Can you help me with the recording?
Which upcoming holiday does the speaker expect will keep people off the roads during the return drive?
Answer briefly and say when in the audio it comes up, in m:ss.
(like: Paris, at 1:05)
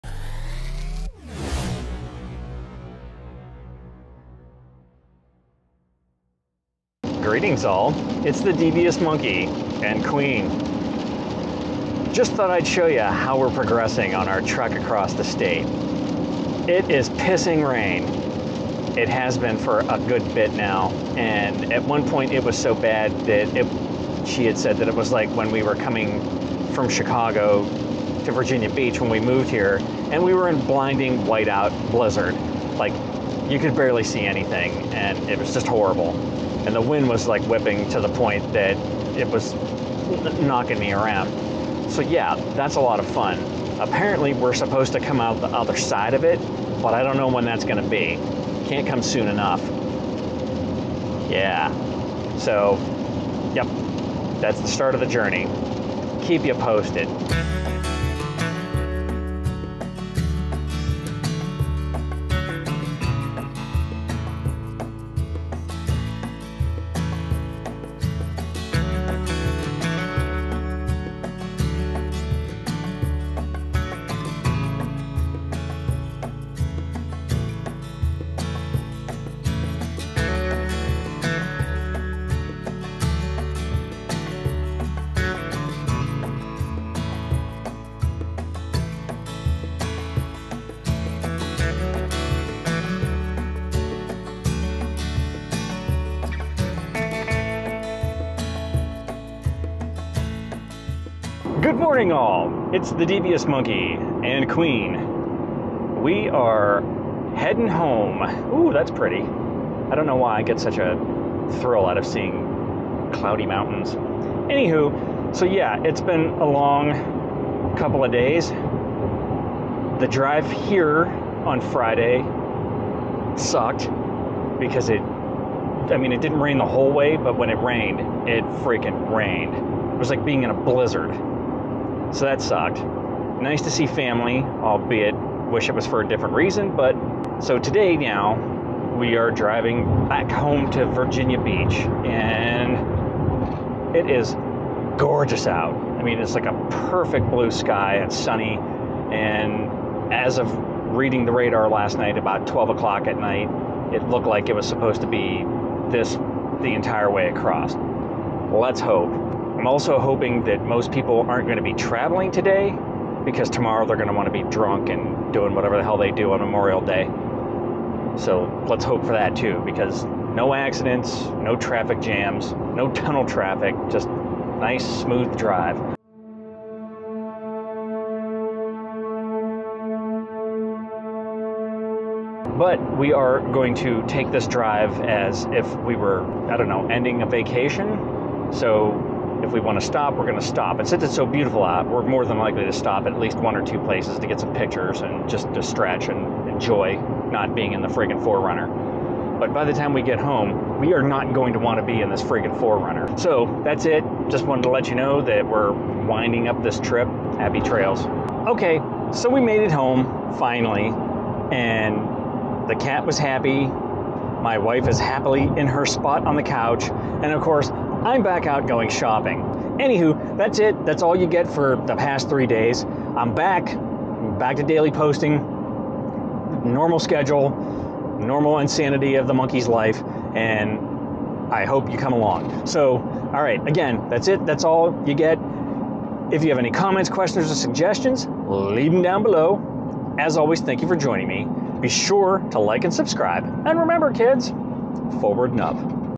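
Memorial Day, at 2:46.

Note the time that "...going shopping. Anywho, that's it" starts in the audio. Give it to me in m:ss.
3:38.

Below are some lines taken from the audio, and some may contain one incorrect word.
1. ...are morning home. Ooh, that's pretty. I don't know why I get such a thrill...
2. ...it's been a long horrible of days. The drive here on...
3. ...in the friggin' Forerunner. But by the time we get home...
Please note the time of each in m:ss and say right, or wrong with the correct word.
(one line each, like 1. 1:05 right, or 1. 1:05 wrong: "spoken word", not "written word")
1. 1:46 wrong: "heading", not "morning"
2. 1:55 wrong: "couple", not "horrible"
3. 3:17 right.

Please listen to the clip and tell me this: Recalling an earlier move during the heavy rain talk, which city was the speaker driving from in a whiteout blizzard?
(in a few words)
Chicago.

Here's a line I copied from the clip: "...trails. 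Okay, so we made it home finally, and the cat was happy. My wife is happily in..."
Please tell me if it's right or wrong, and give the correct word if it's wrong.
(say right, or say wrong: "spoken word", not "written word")
right.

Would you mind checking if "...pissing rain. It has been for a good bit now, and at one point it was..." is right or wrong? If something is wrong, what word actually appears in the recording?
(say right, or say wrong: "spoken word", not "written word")
right.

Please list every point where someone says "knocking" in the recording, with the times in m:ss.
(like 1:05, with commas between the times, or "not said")
0:40.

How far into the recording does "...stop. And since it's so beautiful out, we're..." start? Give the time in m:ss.
3:10.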